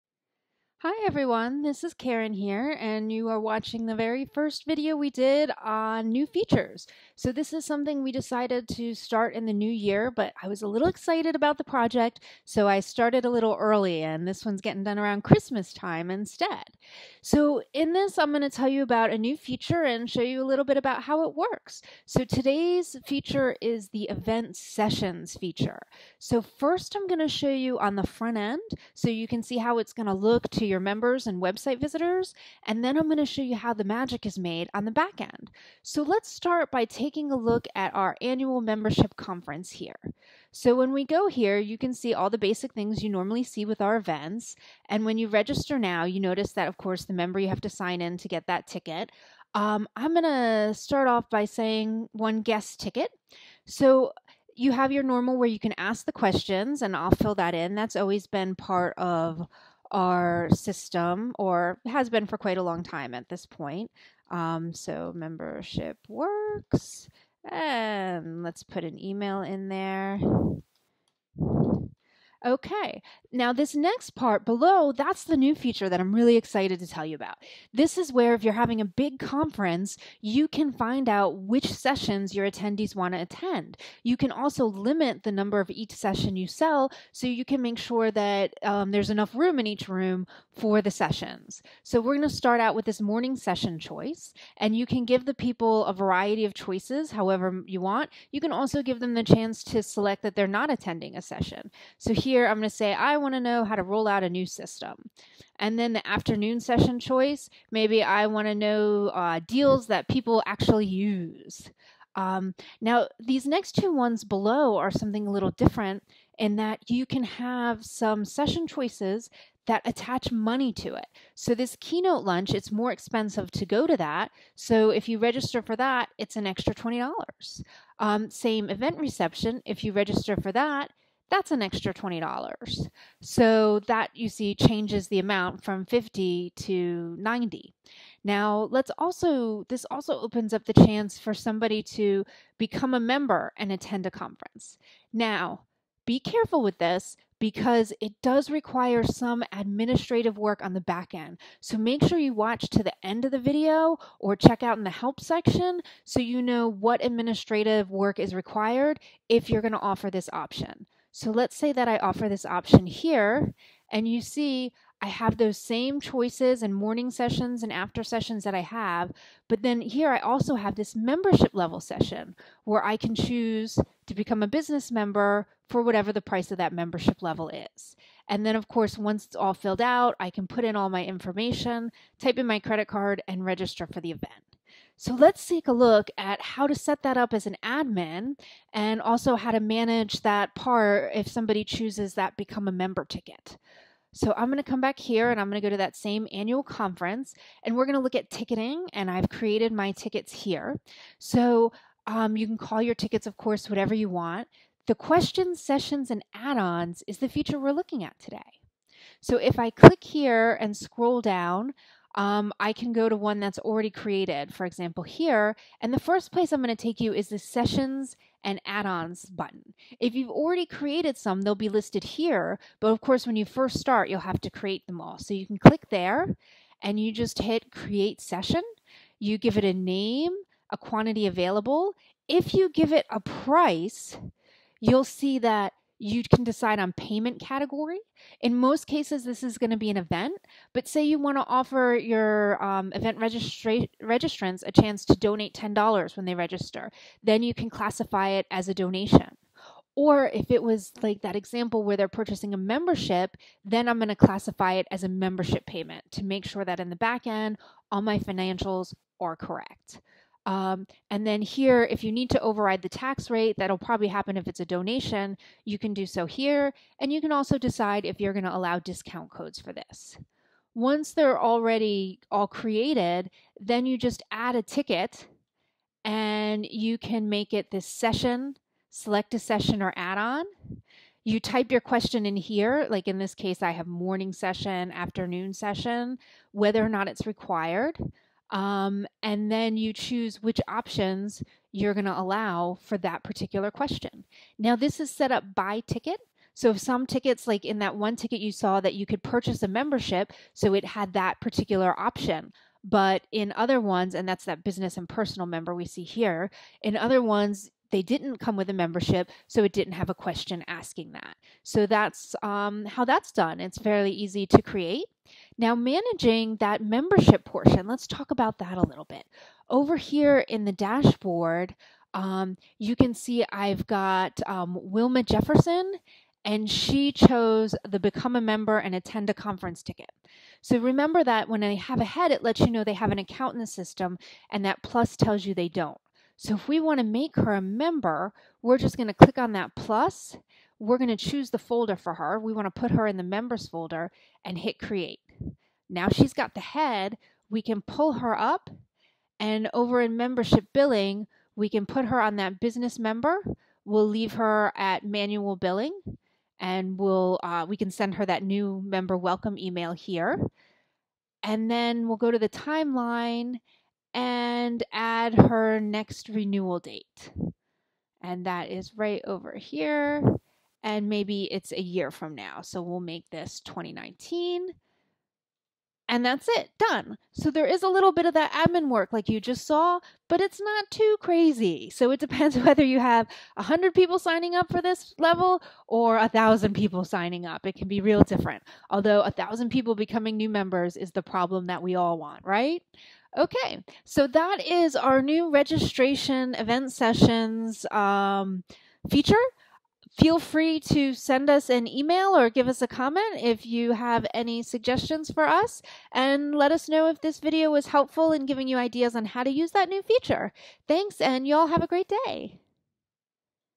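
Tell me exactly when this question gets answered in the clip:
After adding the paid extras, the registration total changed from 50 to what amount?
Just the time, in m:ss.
2:17.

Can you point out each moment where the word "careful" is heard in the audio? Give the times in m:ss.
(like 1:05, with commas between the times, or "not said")
2:26.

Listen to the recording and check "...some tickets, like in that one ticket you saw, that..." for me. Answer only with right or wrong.
right.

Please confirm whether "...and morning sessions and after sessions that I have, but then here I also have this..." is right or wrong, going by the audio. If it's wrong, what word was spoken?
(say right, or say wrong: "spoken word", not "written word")
right.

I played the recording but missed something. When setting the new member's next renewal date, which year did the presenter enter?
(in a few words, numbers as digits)
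2019.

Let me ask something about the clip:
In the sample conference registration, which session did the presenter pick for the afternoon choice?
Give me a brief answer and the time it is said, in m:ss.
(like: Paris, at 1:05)
Deals that people actually use, at 1:49.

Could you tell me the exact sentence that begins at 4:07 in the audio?
Then you can classify it as a donation.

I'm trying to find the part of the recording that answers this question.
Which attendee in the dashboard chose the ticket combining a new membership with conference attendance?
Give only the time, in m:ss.
5:24.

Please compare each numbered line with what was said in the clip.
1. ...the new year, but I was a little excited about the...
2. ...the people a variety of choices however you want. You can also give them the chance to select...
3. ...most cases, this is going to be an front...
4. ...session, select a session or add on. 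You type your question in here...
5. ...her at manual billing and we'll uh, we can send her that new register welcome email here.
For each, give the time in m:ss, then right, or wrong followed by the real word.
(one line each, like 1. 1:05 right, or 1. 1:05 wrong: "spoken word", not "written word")
1. 0:09 right
2. 1:35 right
3. 3:58 wrong: "event", not "front"
4. 4:37 right
5. 5:54 wrong: "member", not "register".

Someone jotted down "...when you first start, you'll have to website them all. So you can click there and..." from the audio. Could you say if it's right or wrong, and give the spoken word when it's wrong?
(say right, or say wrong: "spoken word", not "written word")
wrong: "create", not "website".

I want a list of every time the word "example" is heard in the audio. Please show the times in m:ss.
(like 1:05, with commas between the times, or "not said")
3:34, 4:11.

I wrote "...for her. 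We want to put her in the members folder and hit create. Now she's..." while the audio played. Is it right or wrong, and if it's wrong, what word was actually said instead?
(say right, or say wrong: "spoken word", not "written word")
right.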